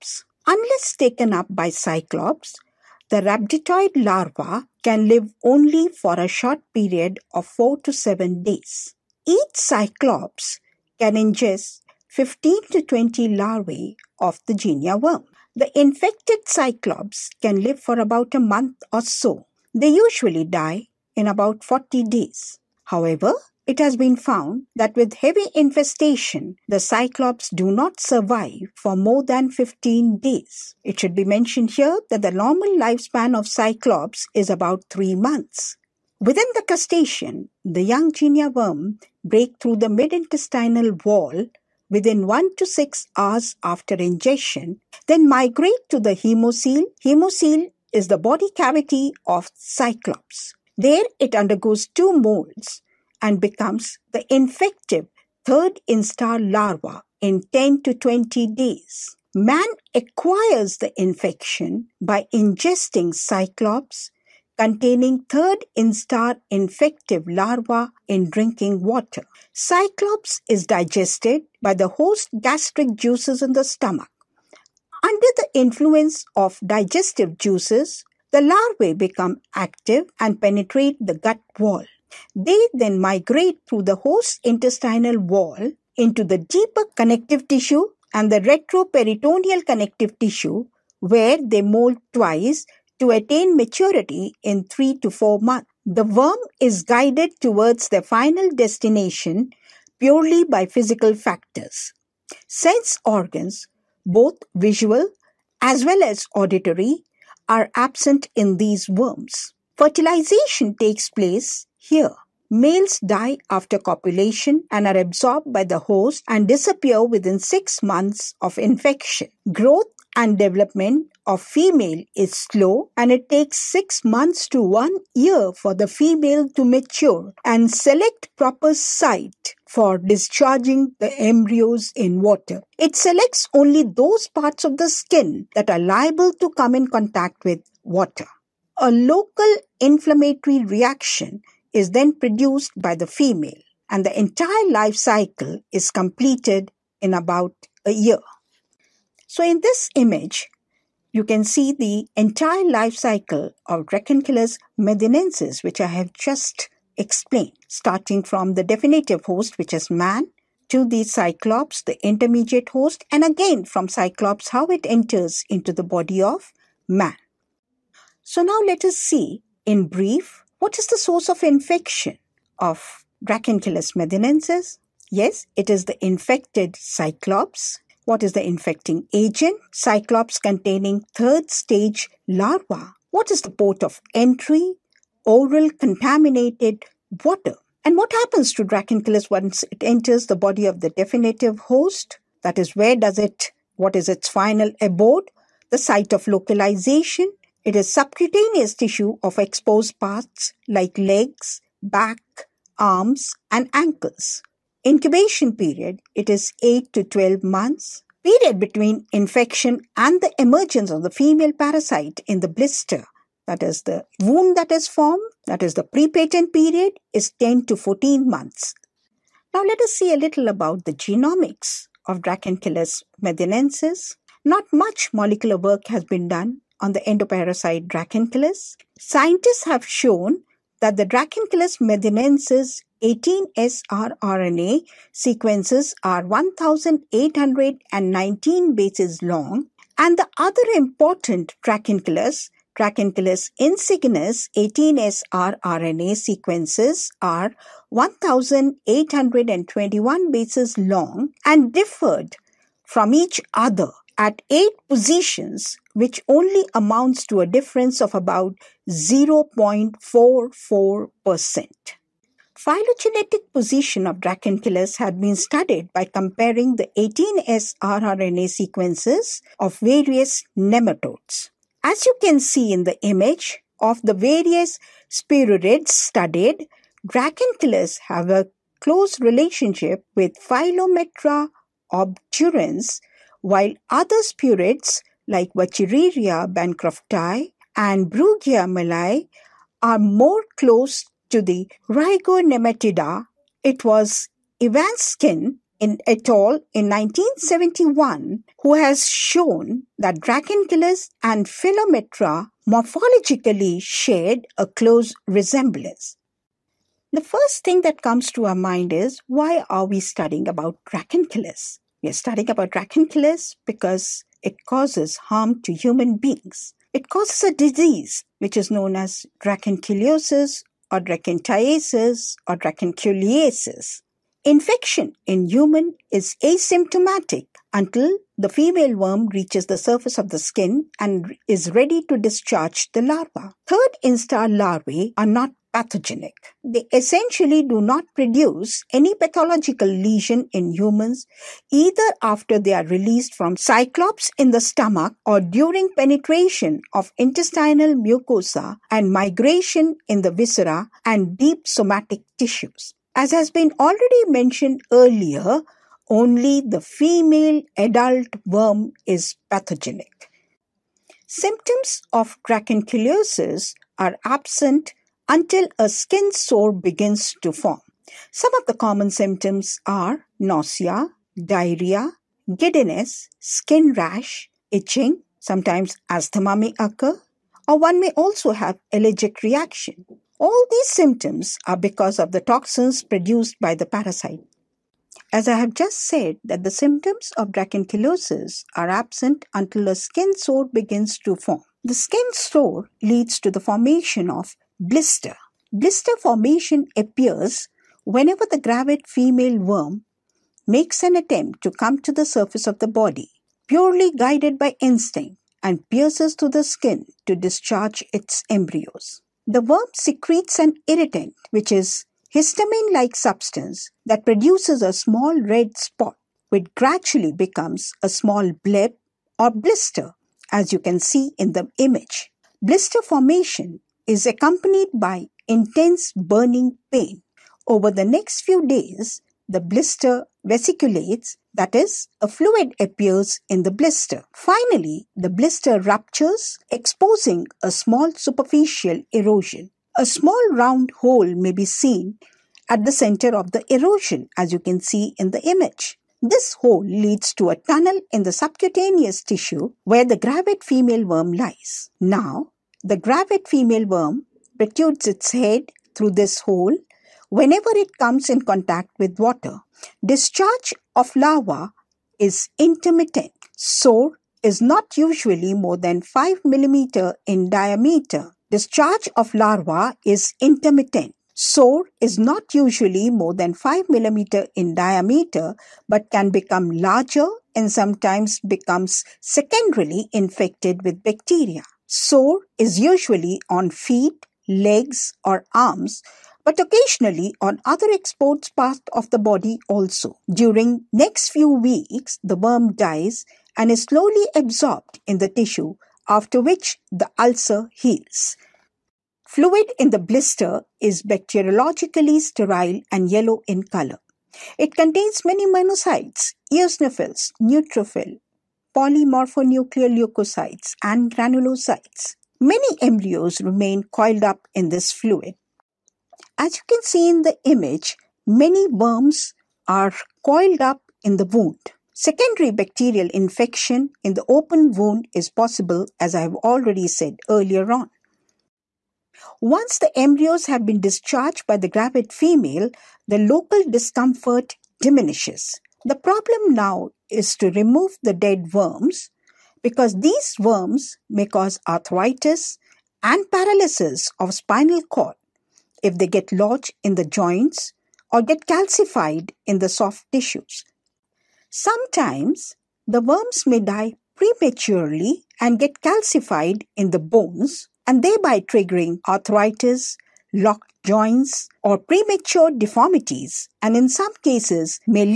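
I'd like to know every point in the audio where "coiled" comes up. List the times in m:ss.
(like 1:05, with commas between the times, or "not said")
8:33, 8:40.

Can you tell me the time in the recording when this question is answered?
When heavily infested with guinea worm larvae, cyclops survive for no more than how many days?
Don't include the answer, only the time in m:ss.
0:29.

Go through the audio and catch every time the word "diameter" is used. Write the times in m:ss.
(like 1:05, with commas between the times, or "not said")
7:47, 7:54.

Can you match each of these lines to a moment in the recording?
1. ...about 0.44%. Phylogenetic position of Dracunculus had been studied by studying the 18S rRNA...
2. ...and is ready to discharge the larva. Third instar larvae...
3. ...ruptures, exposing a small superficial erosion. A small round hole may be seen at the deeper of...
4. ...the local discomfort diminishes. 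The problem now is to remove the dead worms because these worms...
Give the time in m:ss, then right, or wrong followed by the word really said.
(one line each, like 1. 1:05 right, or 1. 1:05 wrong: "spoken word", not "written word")
1. 4:18 wrong: "comparing", not "studying"
2. 5:30 right
3. 7:15 wrong: "center", not "deeper"
4. 8:53 right.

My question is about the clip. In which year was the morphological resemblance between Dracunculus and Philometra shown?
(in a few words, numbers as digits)
1971.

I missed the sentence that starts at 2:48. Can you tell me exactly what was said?
So now let us see in brief what is the source of infection of Dracunculus medinensis?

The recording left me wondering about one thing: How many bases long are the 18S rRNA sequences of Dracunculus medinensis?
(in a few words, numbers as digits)
1,819.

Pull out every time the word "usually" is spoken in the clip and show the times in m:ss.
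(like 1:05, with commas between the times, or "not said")
0:19, 7:44, 7:52, 8:02.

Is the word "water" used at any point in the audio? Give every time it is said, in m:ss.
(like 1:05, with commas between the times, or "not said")
1:08, 2:12, 2:17, 3:07, 7:39.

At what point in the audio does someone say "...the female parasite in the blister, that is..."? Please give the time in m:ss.
3:31.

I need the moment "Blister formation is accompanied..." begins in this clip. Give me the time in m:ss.
7:02.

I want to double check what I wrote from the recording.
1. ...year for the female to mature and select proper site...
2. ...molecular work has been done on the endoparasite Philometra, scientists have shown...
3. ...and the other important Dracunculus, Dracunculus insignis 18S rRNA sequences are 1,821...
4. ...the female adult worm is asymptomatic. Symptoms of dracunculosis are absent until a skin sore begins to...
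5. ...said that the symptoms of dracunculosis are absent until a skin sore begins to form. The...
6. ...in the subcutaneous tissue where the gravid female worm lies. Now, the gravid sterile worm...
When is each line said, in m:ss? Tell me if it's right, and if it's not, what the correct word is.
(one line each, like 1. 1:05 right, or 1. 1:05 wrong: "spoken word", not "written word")
1. 2:05 right
2. 3:45 wrong: "Dracunculus", not "Philometra"
3. 3:59 right
4. 5:56 wrong: "pathogenic", not "asymptomatic"
5. 6:26 right
6. 7:28 wrong: "female", not "sterile".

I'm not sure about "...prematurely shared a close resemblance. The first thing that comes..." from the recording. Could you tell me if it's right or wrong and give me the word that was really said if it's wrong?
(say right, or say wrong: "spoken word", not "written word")
wrong: "morphologically", not "prematurely".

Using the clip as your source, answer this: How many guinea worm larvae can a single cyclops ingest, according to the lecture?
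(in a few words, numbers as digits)
15 to 20.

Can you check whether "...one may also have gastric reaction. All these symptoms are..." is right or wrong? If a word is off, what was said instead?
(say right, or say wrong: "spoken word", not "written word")
wrong: "allergic", not "gastric".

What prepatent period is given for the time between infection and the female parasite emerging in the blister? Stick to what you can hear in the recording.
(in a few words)
10 to 14 months.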